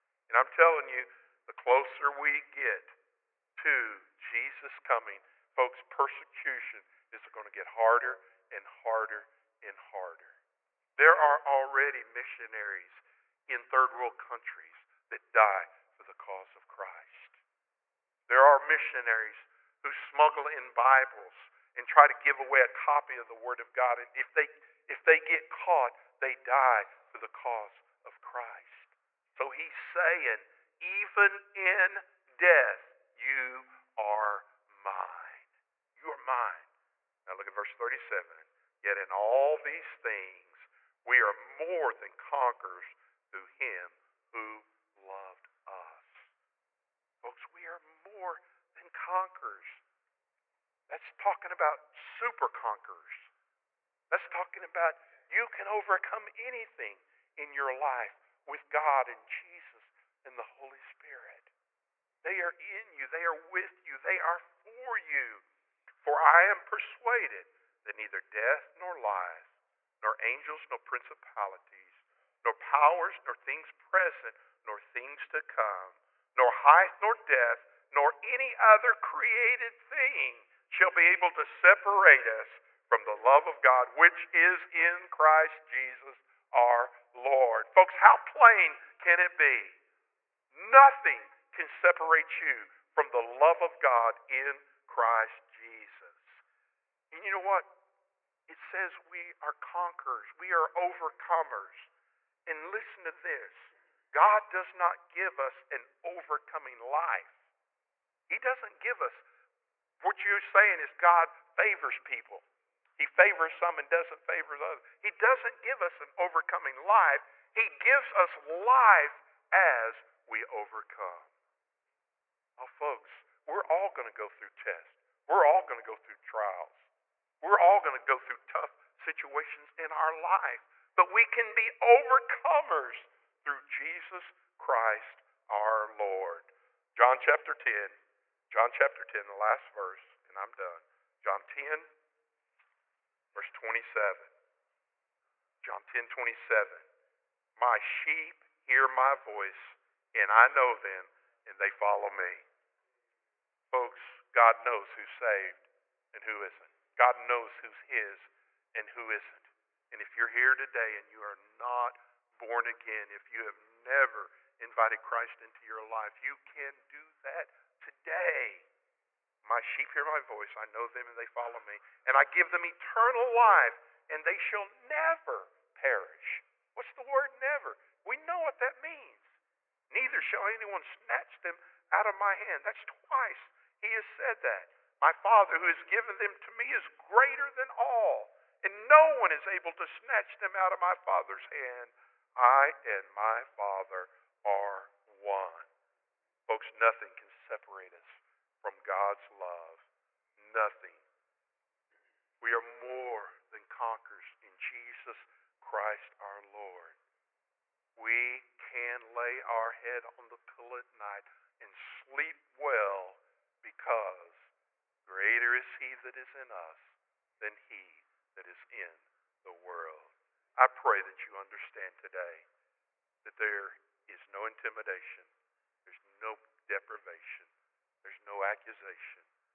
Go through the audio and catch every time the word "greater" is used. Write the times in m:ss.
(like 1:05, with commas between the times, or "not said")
3:06, 3:35.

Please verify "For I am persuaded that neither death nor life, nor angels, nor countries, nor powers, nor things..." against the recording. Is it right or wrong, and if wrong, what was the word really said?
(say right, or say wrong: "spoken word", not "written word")
wrong: "principalities", not "countries".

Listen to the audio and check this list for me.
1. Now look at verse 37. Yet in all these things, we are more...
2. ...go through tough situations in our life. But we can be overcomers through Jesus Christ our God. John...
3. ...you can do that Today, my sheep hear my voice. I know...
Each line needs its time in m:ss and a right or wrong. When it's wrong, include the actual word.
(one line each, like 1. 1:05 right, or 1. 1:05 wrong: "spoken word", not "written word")
1. 0:37 right
2. 2:08 wrong: "Lord", not "God"
3. 2:46 right.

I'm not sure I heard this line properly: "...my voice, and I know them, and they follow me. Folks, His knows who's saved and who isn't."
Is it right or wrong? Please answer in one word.
wrong.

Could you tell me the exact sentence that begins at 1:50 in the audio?
What you're saying is God favors people.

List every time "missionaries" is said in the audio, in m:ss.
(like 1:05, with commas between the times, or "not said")
0:12, 0:18.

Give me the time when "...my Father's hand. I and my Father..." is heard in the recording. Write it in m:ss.
3:10.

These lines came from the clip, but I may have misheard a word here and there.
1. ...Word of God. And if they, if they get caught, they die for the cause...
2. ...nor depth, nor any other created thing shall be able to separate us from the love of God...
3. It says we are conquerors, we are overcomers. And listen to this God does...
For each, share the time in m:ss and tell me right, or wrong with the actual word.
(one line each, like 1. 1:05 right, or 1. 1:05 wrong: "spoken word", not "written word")
1. 0:23 right
2. 1:17 right
3. 1:38 right.